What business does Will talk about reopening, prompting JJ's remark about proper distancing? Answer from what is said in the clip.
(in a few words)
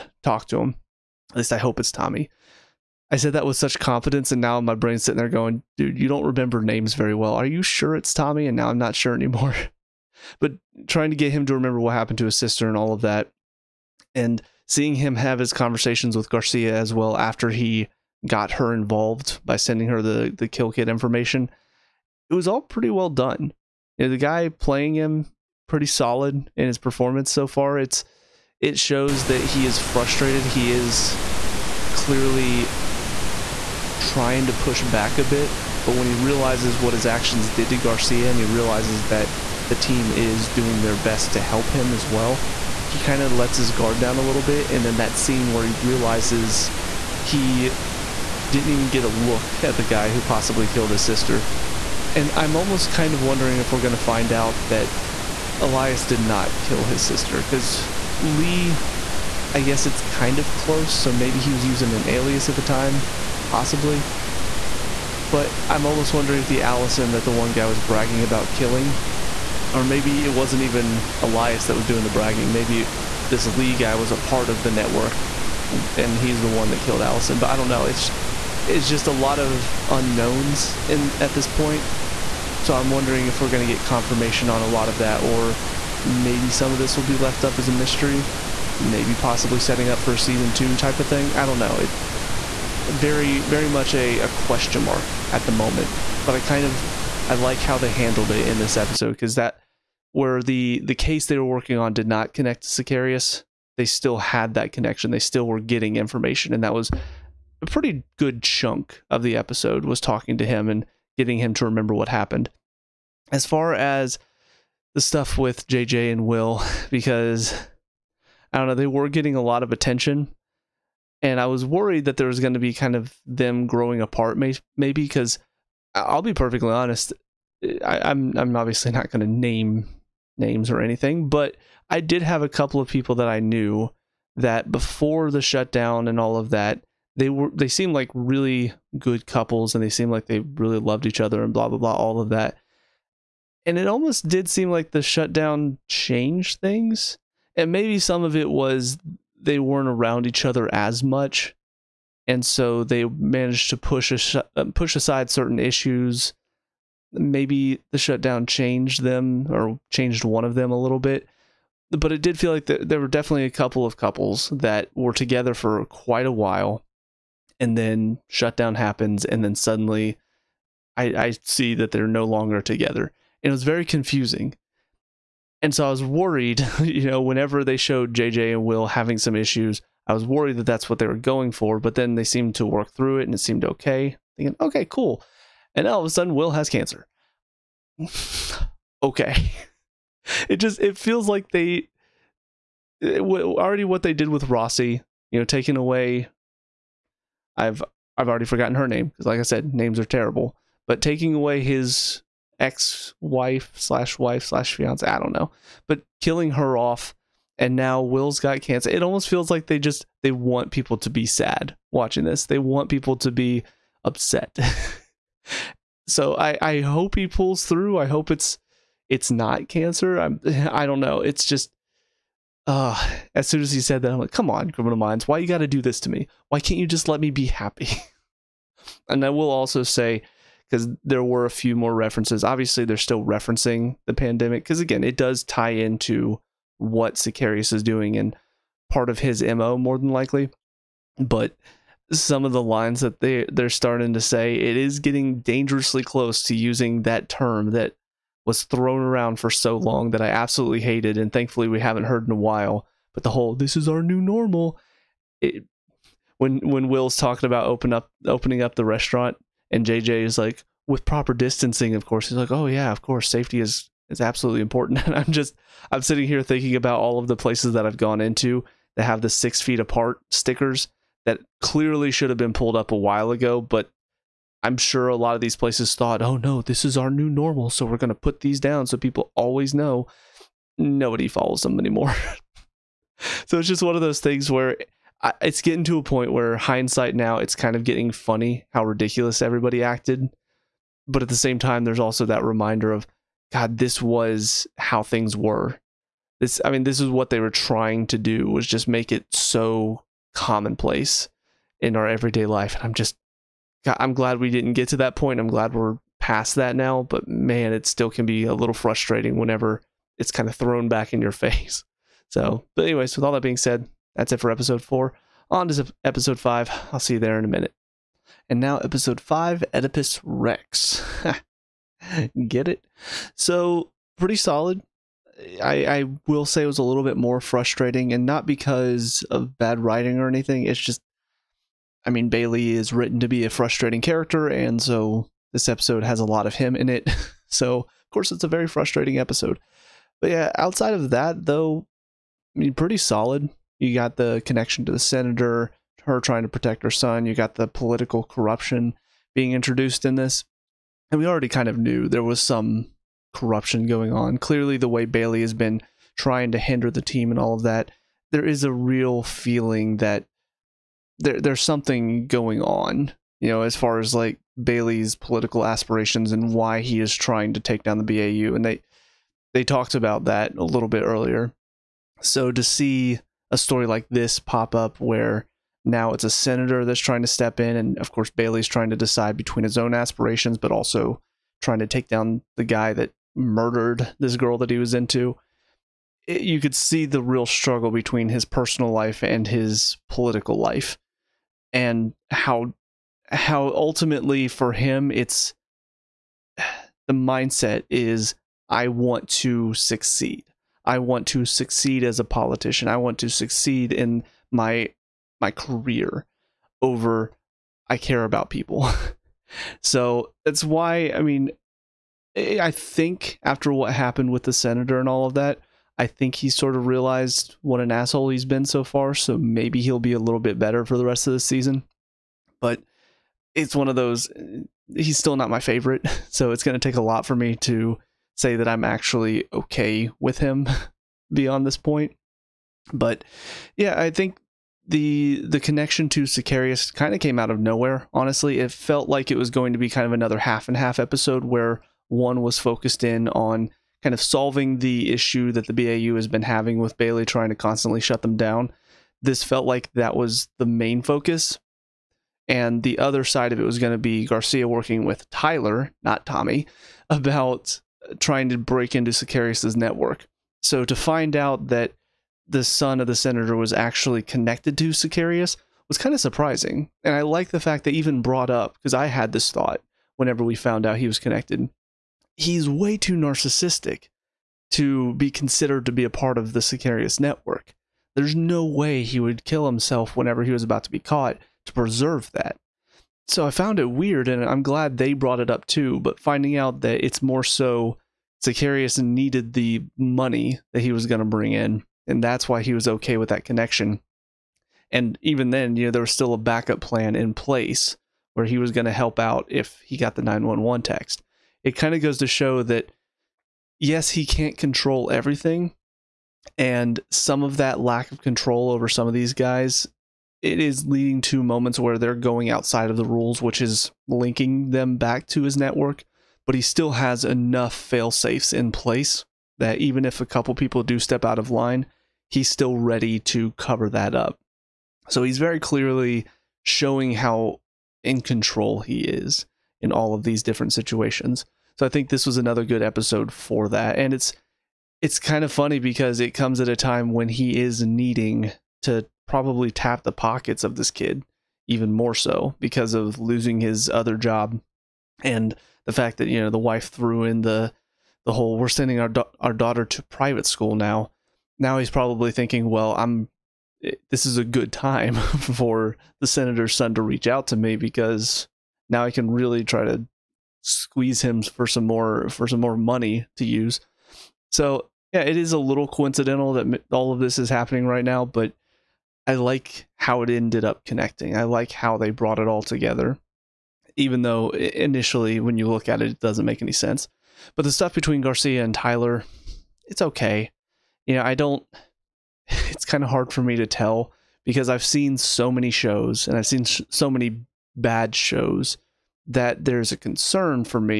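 The restaurant.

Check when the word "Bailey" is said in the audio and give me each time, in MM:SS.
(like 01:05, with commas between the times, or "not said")
05:32, 05:55, 06:04, 06:18, 07:26.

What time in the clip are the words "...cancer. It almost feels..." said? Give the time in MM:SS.
03:28.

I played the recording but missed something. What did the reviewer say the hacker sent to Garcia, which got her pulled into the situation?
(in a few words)
The kill kit information.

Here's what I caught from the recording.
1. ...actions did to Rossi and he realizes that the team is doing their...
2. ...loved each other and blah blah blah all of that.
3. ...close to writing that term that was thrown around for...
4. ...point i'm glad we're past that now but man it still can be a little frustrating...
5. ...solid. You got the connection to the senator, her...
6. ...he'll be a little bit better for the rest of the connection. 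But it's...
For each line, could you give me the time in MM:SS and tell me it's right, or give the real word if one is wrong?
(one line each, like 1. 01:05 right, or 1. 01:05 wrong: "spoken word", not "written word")
1. 00:37 wrong: "Garcia", not "Rossi"
2. 02:20 right
3. 04:06 wrong: "using", not "writing"
4. 05:05 right
5. 05:42 right
6. 06:59 wrong: "season", not "connection".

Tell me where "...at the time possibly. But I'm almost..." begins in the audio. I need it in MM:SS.
01:02.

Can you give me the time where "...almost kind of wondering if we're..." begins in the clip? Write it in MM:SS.
00:52.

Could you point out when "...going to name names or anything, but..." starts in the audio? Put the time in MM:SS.
02:09.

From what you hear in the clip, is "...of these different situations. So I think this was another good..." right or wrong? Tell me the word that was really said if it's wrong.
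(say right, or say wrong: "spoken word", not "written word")
right.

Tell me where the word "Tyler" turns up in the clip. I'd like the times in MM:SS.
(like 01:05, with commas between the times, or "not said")
07:35, 09:38.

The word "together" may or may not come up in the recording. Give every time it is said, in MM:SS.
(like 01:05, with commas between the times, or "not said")
02:45, 02:52, 09:32.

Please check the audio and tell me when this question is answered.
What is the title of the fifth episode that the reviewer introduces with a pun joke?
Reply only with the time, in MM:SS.
05:19.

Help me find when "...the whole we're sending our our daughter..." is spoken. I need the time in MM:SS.
09:08.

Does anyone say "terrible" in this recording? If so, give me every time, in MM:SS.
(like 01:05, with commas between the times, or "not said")
03:20.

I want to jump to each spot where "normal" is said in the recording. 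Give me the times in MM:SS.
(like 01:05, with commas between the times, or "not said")
04:14, 04:37.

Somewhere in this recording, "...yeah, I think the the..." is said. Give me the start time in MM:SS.
07:13.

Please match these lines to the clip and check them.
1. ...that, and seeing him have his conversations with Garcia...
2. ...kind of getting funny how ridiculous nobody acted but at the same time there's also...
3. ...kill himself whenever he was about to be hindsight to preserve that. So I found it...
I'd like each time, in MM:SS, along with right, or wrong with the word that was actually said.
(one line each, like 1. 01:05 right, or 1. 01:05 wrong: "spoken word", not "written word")
1. 00:13 right
2. 04:47 wrong: "everybody", not "nobody"
3. 07:59 wrong: "caught", not "hindsight".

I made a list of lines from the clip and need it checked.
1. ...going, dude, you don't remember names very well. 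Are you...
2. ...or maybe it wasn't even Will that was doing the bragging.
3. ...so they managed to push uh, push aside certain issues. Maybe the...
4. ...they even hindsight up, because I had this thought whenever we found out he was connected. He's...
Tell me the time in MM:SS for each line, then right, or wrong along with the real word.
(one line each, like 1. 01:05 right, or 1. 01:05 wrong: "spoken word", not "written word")
1. 00:05 right
2. 01:09 wrong: "Elias", not "Will"
3. 02:32 right
4. 07:47 wrong: "brought", not "hindsight".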